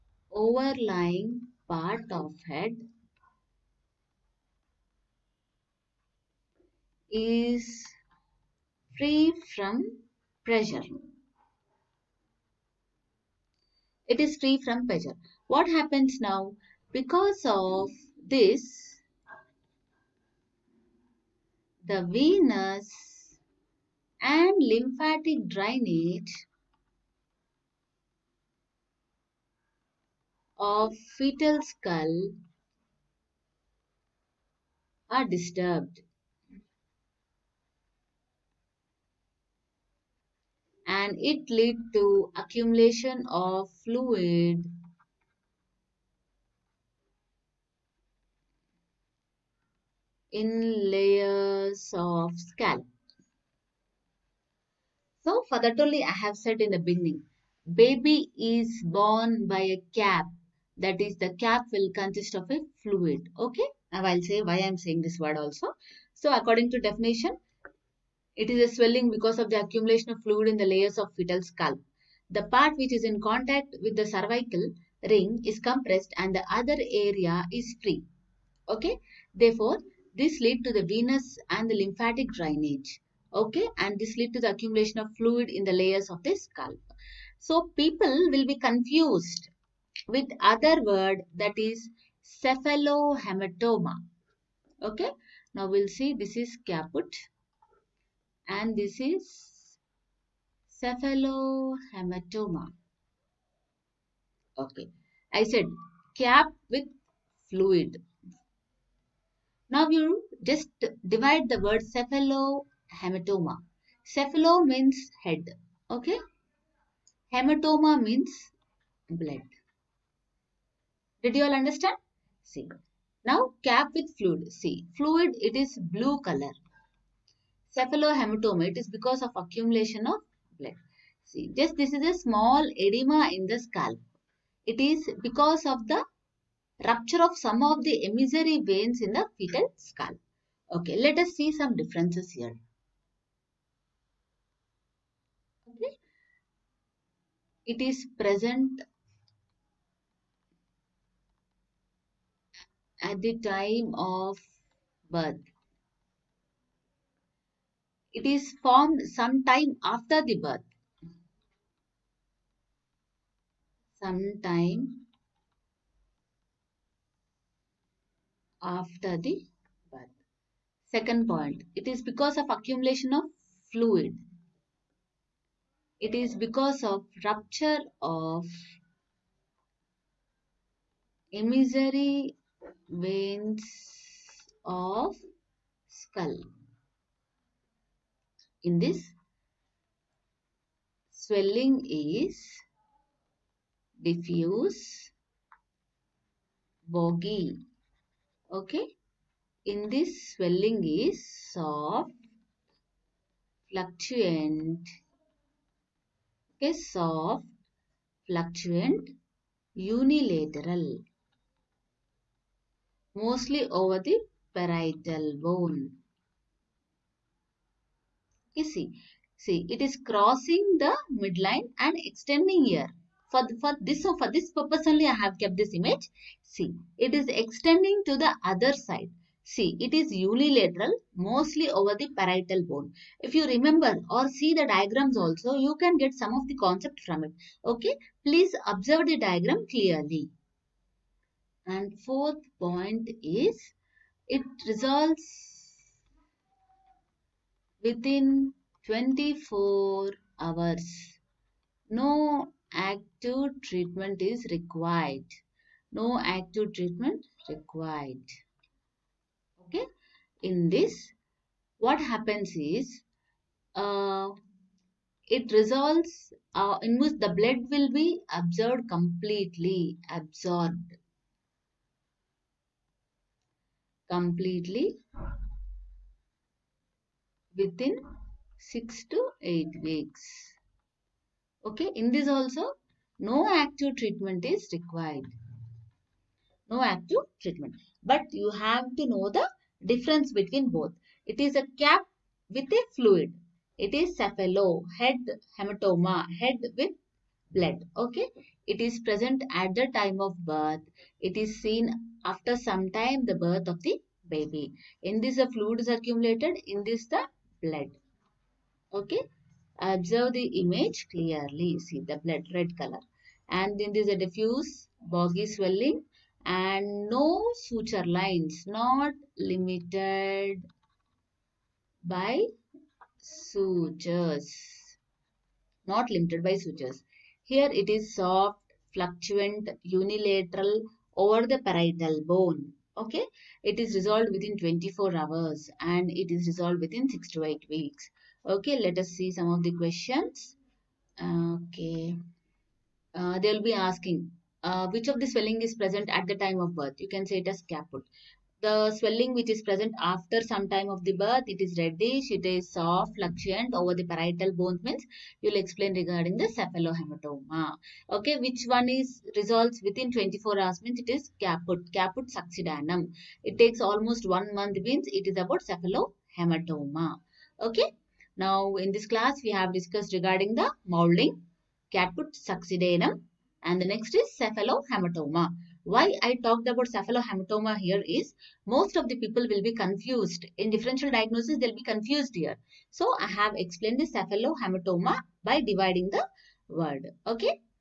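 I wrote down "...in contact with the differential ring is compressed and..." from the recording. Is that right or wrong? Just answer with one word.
wrong.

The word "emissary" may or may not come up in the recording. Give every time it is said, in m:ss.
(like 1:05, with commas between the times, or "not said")
2:18, 3:01.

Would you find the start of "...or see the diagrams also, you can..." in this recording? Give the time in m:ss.
3:54.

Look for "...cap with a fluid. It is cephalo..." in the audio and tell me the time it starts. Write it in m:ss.
4:51.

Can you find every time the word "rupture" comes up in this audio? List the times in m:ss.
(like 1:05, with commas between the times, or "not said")
2:16, 2:57.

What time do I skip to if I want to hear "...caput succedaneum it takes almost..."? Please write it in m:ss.
6:01.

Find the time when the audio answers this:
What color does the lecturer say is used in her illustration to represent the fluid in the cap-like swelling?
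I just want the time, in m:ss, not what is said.
2:05.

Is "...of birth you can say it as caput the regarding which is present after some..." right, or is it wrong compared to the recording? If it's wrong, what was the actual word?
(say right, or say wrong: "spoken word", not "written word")
wrong: "swelling", not "regarding".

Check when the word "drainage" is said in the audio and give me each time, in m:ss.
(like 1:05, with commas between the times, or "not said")
0:25, 1:22.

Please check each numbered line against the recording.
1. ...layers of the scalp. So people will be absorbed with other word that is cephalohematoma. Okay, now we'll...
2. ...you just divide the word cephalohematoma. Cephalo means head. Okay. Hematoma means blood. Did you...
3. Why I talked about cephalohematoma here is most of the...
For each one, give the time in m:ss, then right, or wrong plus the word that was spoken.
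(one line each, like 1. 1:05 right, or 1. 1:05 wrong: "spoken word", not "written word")
1. 1:25 wrong: "confused", not "absorbed"
2. 1:49 right
3. 6:15 right.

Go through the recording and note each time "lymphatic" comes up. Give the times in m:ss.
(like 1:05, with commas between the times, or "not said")
0:24, 1:21.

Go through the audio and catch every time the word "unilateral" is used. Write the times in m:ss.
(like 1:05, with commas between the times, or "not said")
3:29, 3:50, 5:29.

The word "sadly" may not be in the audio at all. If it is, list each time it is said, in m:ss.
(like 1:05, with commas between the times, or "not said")
not said.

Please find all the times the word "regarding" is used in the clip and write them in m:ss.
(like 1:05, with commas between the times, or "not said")
5:55, 6:10.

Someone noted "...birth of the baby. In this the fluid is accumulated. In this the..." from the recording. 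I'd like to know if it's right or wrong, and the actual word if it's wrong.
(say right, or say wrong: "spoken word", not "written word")
right.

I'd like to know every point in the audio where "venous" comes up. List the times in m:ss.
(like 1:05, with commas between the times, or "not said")
0:22, 1:20.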